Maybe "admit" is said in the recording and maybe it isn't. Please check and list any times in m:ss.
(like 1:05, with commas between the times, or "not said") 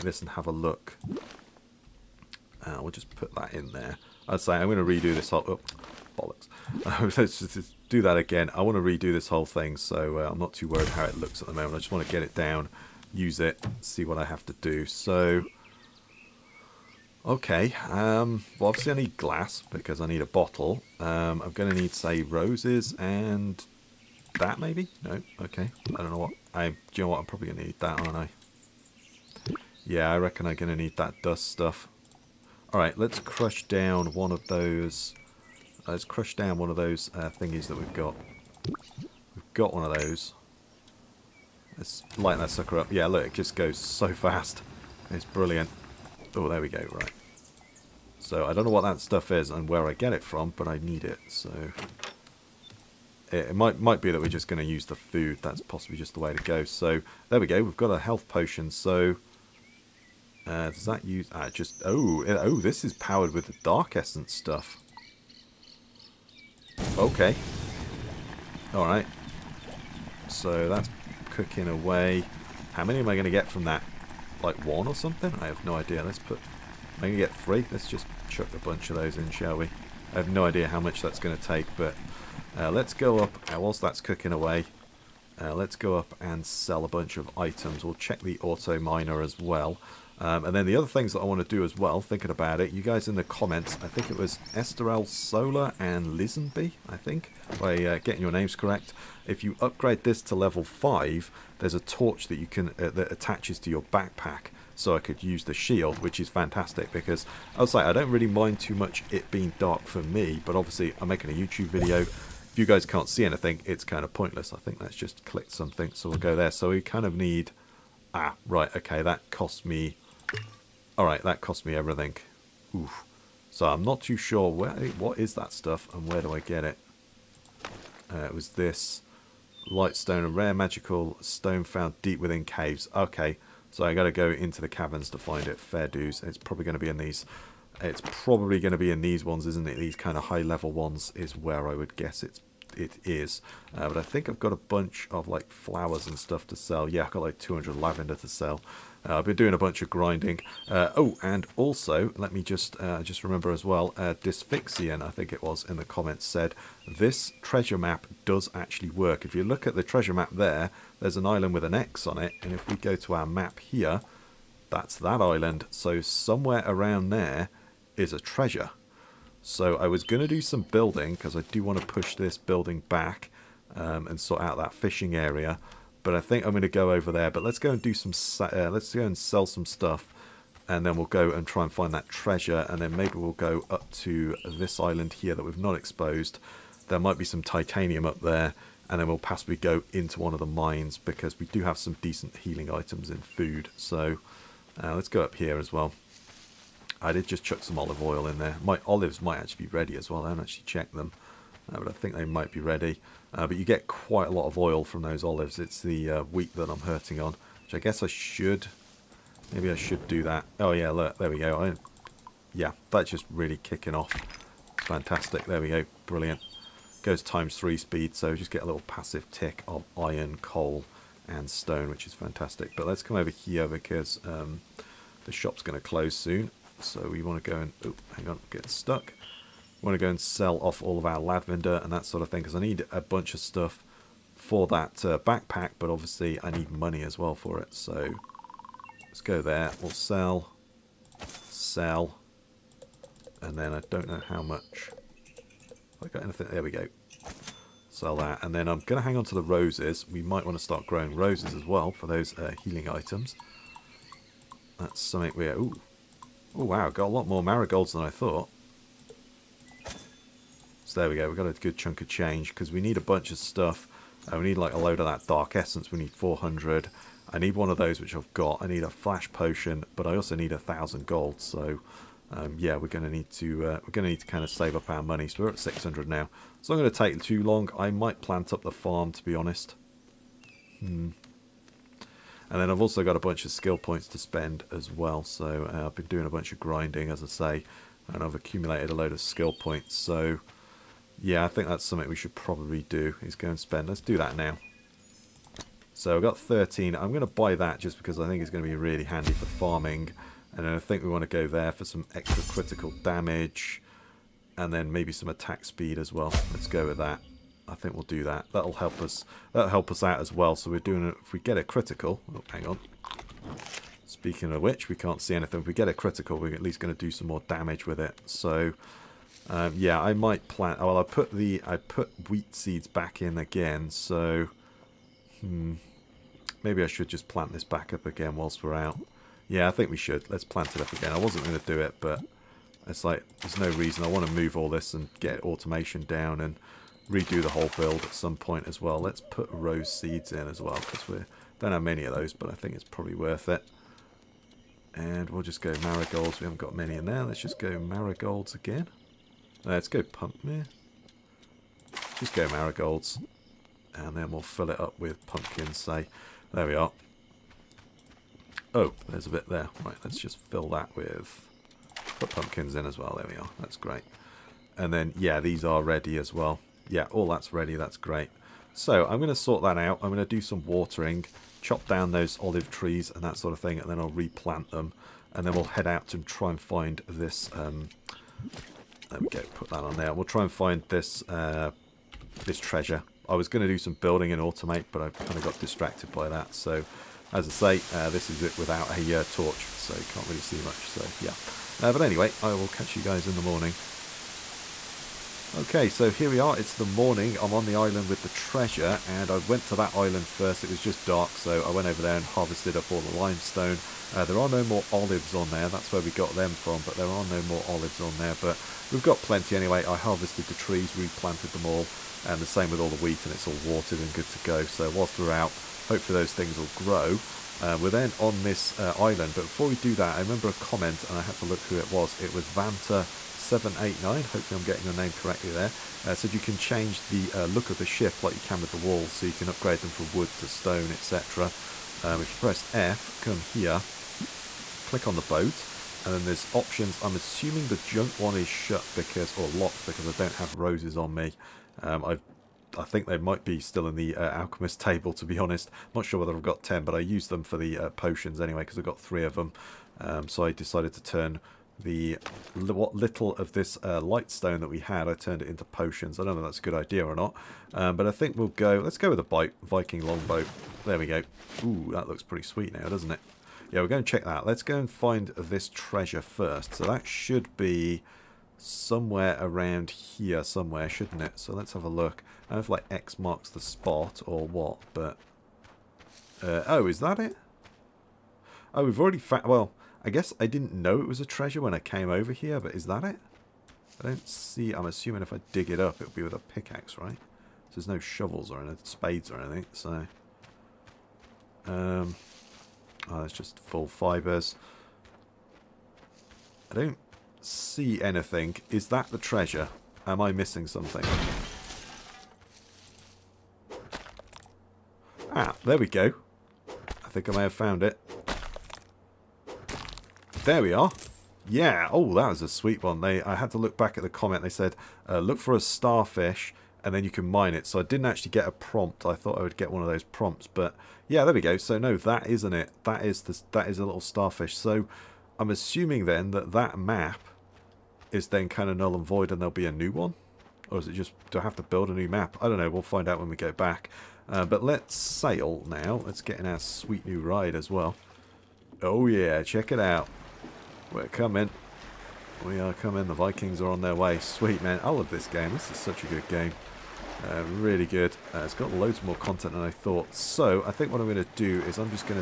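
not said.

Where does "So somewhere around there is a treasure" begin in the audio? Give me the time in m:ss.
2:45.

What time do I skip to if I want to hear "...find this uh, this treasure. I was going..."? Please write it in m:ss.
6:20.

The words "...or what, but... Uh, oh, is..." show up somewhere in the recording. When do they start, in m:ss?
7:54.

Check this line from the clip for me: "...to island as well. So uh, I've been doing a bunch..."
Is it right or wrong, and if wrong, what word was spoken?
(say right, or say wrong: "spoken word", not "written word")
wrong: "spend", not "island".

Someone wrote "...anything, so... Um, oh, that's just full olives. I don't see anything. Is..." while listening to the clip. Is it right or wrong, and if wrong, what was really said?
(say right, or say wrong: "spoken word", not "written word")
wrong: "fibres", not "olives".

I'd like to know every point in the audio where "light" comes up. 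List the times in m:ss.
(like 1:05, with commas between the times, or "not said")
0:42, 2:09, 7:33.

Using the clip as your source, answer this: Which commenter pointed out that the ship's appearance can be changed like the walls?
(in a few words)
Vanta789.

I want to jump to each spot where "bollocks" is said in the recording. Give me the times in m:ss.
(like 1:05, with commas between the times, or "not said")
0:06.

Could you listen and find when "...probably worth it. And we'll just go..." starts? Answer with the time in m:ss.
5:42.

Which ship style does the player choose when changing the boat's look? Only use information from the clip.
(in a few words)
Viking longboat.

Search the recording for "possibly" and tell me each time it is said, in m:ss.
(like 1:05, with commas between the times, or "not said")
0:55, 3:09.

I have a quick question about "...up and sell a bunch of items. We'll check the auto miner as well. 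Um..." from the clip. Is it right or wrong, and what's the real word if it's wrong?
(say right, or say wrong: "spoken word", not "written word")
right.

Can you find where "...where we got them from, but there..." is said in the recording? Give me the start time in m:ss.
6:45.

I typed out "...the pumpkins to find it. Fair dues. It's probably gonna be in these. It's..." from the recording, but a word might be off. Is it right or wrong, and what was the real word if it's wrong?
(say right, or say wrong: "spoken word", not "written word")
wrong: "caverns", not "pumpkins".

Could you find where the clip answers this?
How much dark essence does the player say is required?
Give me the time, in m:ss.
4:26.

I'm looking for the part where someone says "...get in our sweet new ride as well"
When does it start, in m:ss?
8:56.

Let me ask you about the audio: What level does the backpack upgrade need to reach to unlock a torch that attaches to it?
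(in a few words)
5.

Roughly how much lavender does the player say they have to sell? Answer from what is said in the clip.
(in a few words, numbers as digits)
200.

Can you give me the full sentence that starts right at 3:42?
But let's come over here because um, the shop's going to close soon.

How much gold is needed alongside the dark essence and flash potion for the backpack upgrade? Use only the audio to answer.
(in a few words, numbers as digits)
1000.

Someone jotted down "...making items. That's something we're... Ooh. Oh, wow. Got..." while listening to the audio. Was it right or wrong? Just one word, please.
wrong.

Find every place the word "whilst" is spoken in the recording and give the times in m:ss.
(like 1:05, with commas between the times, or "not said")
1:23, 5:28, 6:54.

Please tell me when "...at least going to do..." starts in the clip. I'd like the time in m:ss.
5:16.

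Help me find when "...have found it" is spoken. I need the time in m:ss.
8:27.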